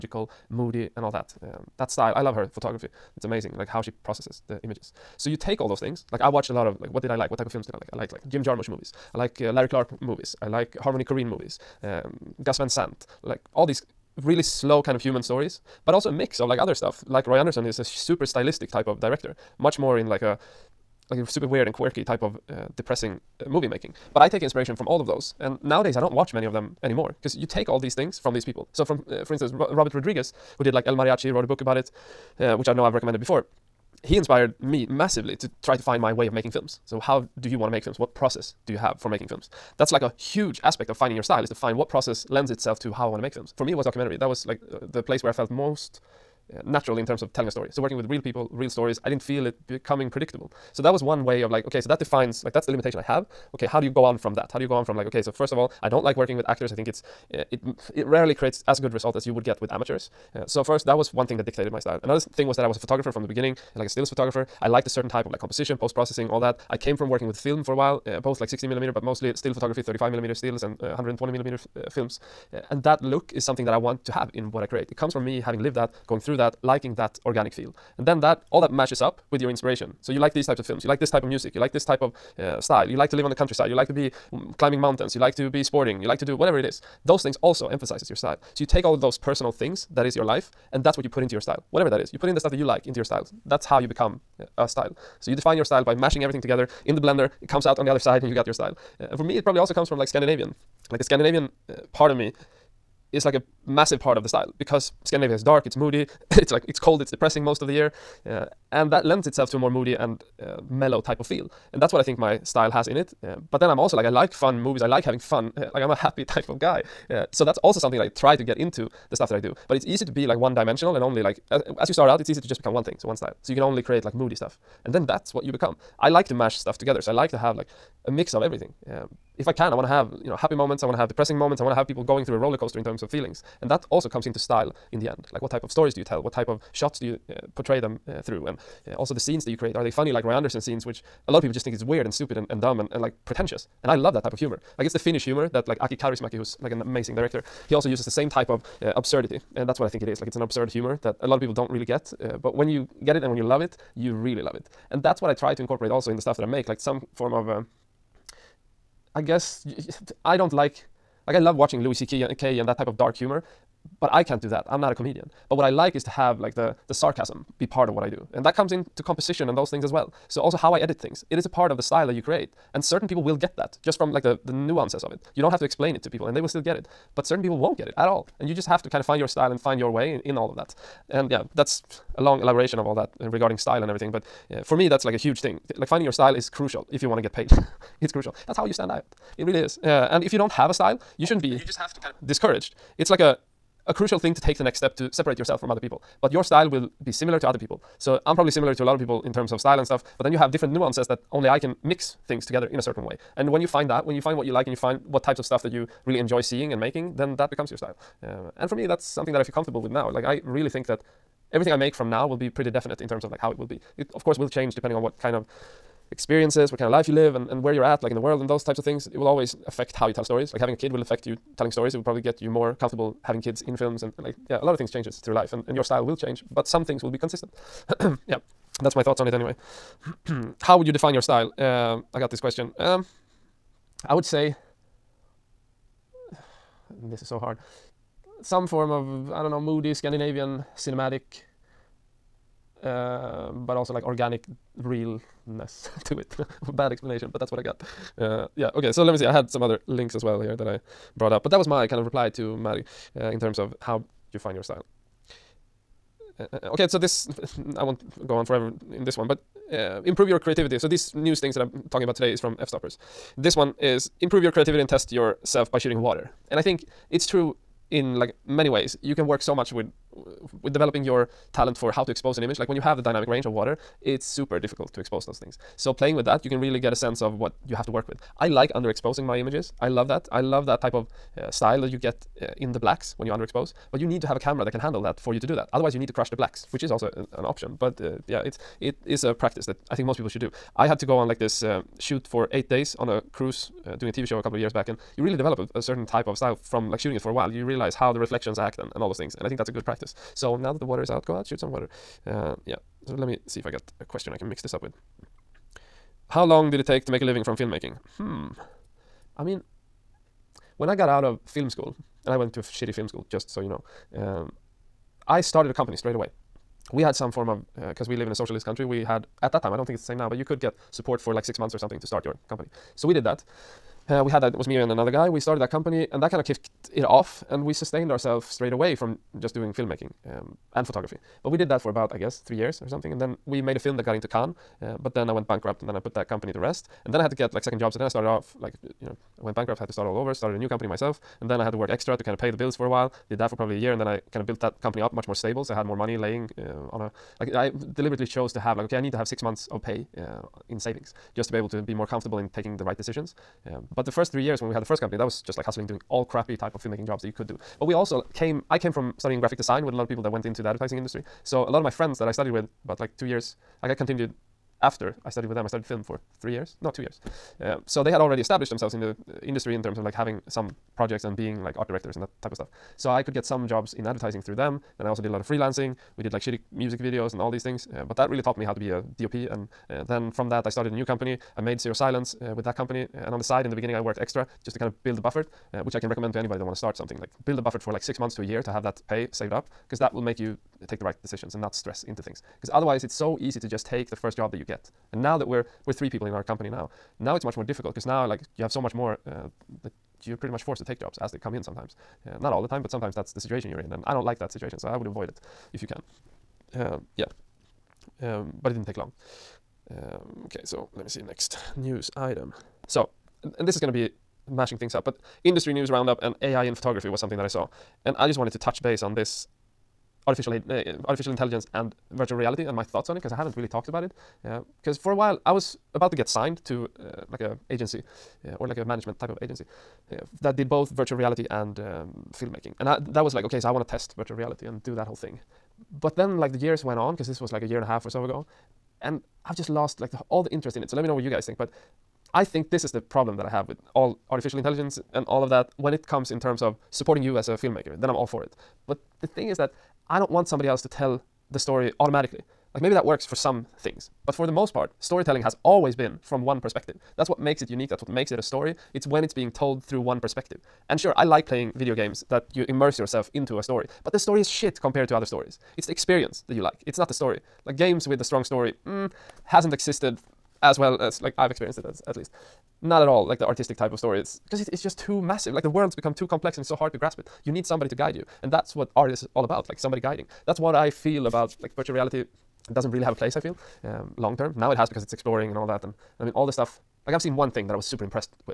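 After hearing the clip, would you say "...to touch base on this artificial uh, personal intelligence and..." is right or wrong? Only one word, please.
wrong.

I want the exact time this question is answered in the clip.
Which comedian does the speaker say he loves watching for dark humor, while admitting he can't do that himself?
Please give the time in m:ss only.
2:41.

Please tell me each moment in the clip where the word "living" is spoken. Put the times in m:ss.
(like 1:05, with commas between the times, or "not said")
5:07.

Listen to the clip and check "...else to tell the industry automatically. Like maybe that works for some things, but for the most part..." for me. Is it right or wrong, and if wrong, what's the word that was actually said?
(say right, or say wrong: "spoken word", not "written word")
wrong: "story", not "industry".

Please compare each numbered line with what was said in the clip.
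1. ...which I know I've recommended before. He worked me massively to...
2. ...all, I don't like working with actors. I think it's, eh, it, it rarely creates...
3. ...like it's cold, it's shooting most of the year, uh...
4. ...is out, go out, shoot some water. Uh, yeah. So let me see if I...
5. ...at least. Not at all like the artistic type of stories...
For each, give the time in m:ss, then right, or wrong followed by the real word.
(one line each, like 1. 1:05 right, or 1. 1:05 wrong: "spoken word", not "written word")
1. 0:32 wrong: "inspired", not "worked"
2. 0:55 right
3. 1:46 wrong: "depressing", not "shooting"
4. 5:01 right
5. 7:52 right.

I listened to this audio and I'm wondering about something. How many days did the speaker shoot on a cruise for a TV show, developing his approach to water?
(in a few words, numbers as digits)
8.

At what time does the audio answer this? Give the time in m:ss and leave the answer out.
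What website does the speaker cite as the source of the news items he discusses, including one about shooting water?
4:22.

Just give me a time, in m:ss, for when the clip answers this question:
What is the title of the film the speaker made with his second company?
6:21.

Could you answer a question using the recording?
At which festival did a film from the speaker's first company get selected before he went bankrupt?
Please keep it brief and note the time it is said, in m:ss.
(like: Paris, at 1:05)
Cannes, at 5:34.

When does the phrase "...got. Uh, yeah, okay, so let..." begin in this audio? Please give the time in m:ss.
4:07.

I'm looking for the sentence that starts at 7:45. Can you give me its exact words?
It's the experience that you like, it's not the story.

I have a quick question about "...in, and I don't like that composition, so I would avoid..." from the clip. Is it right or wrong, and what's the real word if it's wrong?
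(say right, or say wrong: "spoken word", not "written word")
wrong: "situation", not "composition".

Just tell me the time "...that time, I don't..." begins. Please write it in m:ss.
5:19.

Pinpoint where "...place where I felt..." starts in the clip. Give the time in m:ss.
0:45.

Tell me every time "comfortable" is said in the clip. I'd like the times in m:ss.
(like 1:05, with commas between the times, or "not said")
3:29, 3:42, 5:52.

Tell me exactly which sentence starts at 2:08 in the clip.
Um, if I can, I want to have you know happy moments.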